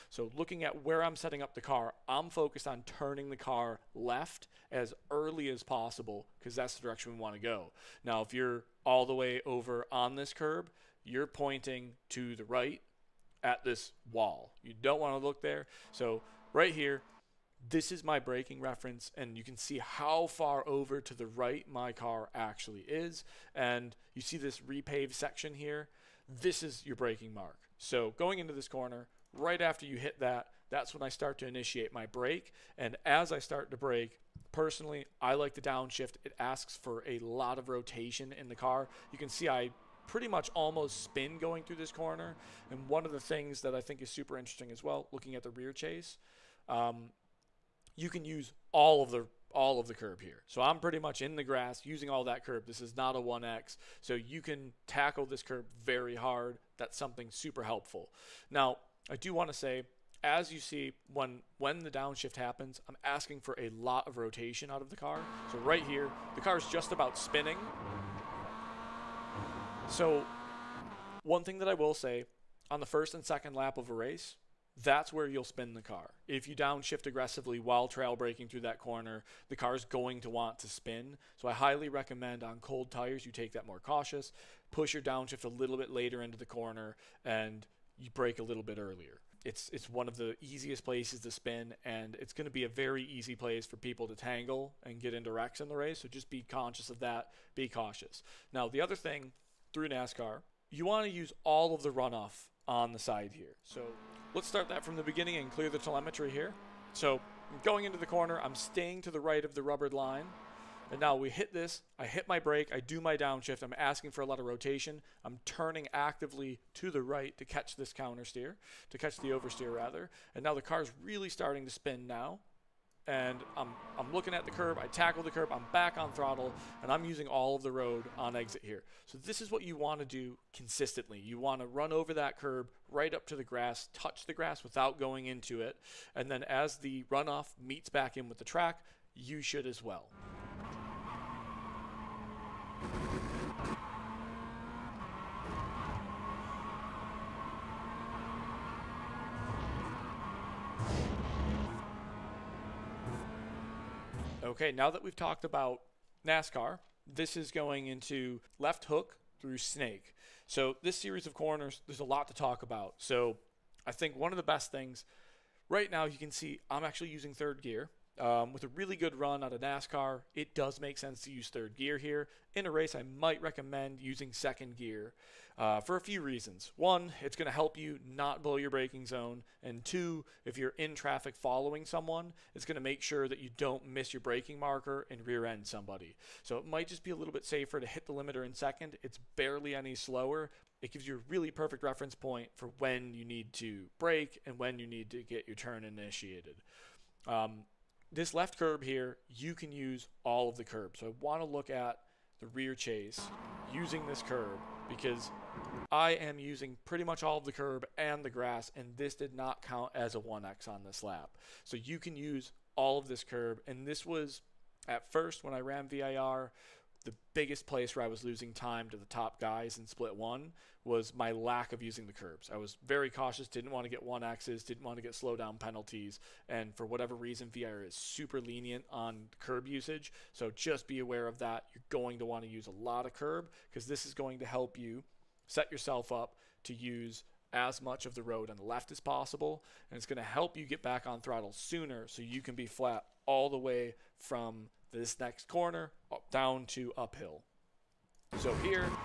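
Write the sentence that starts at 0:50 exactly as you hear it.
So I'm pretty much in the grass using all that curb.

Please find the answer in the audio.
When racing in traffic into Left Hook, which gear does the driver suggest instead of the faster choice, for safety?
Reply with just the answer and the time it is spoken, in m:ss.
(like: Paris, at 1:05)
second gear, at 2:54.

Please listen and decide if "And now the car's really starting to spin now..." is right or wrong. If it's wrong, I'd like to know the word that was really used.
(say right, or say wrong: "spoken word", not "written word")
right.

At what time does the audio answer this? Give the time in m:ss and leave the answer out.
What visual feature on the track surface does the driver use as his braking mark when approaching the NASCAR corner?
0:24.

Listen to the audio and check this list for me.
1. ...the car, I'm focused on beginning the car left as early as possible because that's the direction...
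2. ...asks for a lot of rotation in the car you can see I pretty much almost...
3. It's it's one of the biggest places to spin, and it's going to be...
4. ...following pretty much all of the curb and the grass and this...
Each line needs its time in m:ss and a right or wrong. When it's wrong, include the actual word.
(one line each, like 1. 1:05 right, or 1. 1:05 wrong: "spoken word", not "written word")
1. 0:01 wrong: "turning", not "beginning"
2. 0:36 right
3. 1:29 wrong: "easiest", not "biggest"
4. 3:26 wrong: "using", not "following".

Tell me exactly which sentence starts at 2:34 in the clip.
Okay, now that we've talked about NASCAR, this is going into left hook through snake.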